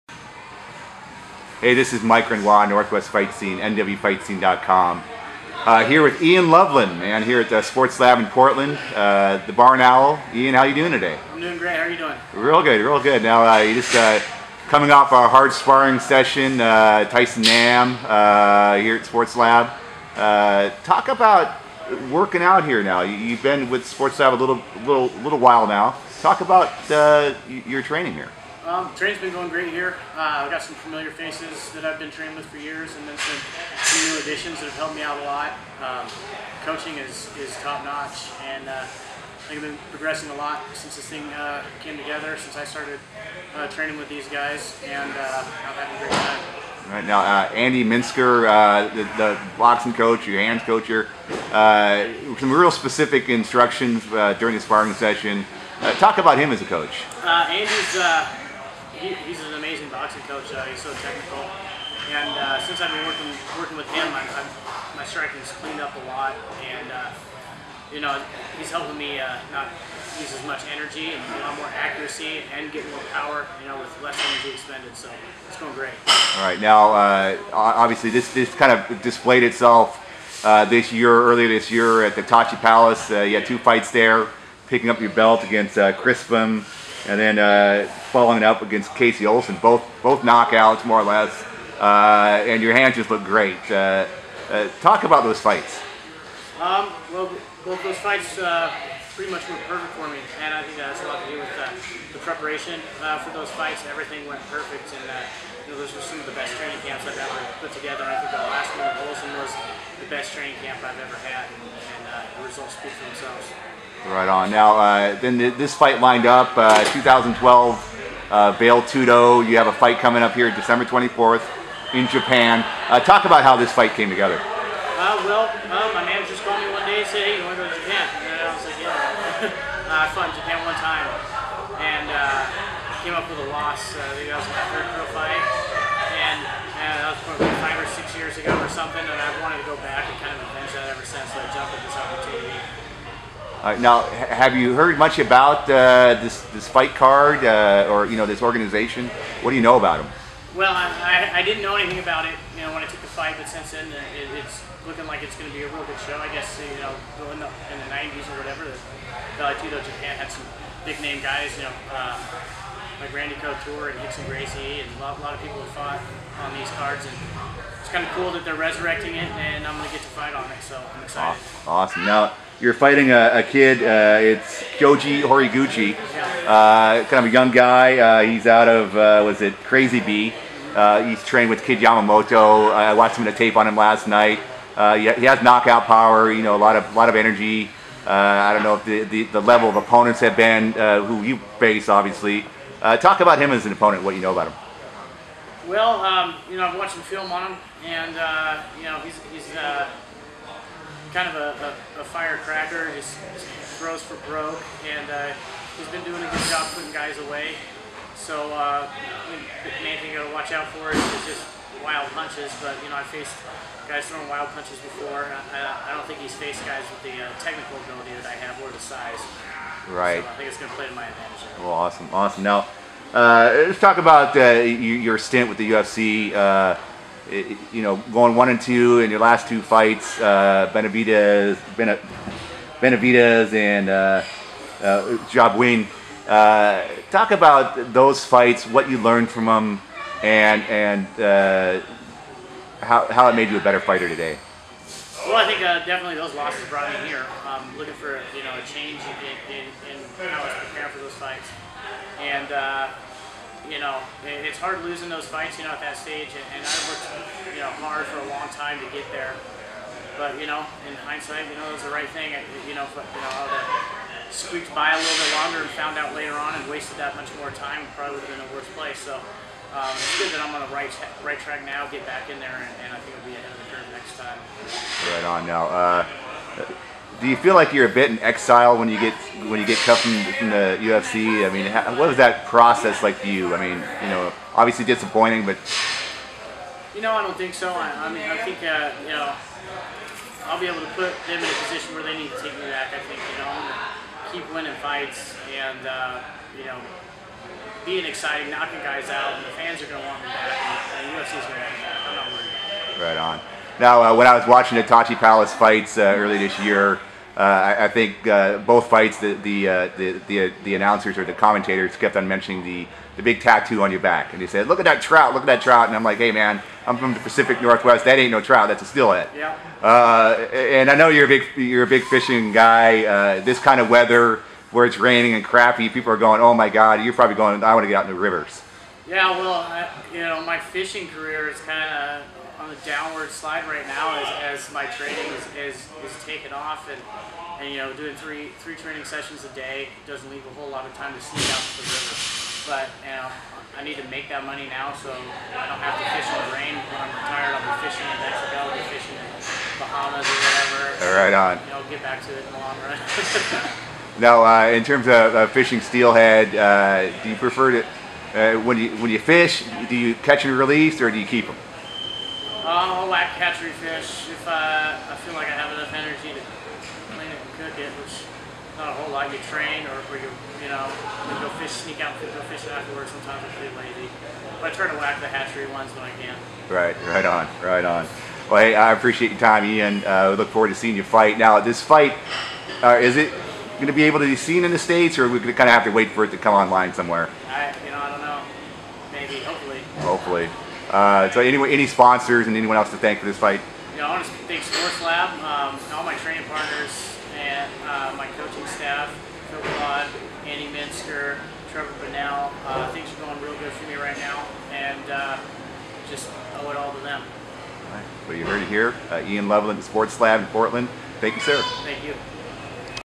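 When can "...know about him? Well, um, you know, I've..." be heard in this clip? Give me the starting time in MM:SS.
03:14.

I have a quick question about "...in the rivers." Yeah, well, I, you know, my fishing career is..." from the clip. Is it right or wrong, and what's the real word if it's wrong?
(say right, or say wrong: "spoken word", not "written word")
right.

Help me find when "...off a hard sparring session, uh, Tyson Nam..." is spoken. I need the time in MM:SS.
00:14.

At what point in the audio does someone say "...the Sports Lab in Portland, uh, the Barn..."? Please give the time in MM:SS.
00:07.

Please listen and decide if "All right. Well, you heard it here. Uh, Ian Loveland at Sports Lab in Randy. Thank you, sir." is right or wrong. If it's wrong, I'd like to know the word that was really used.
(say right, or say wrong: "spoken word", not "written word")
wrong: "Portland", not "Randy".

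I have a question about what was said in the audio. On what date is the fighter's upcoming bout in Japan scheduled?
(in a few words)
December 24.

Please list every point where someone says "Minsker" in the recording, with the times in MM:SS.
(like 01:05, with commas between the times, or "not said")
00:47, 06:40.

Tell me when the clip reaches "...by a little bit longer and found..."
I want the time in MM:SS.
04:24.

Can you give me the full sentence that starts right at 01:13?
You know, with less energy expended.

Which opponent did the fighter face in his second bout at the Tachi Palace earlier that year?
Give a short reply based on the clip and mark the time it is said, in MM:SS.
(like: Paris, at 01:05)
Casey Olson, at 01:28.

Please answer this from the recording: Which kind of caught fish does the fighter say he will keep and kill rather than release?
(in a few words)
Hatchery fish.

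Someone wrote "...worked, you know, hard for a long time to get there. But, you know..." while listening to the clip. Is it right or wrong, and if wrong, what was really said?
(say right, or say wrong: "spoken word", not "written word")
right.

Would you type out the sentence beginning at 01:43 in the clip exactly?
Everything went perfect, and you know, those were some of the best training camps I've ever put together.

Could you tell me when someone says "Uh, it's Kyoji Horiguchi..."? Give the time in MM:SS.
02:53.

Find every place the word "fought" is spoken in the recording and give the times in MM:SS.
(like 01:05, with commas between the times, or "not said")
02:10, 02:45.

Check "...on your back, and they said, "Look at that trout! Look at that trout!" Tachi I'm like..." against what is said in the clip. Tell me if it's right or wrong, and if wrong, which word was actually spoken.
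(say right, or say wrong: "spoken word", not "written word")
wrong: "And", not "Tachi".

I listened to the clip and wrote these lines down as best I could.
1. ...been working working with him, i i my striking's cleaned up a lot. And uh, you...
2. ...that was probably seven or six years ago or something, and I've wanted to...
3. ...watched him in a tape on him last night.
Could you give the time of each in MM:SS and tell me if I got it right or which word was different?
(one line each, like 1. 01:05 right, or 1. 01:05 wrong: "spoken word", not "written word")
1. 01:02 right
2. 02:17 wrong: "five", not "seven"
3. 03:02 right.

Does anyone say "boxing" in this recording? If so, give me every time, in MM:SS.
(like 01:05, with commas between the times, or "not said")
00:49, 00:59.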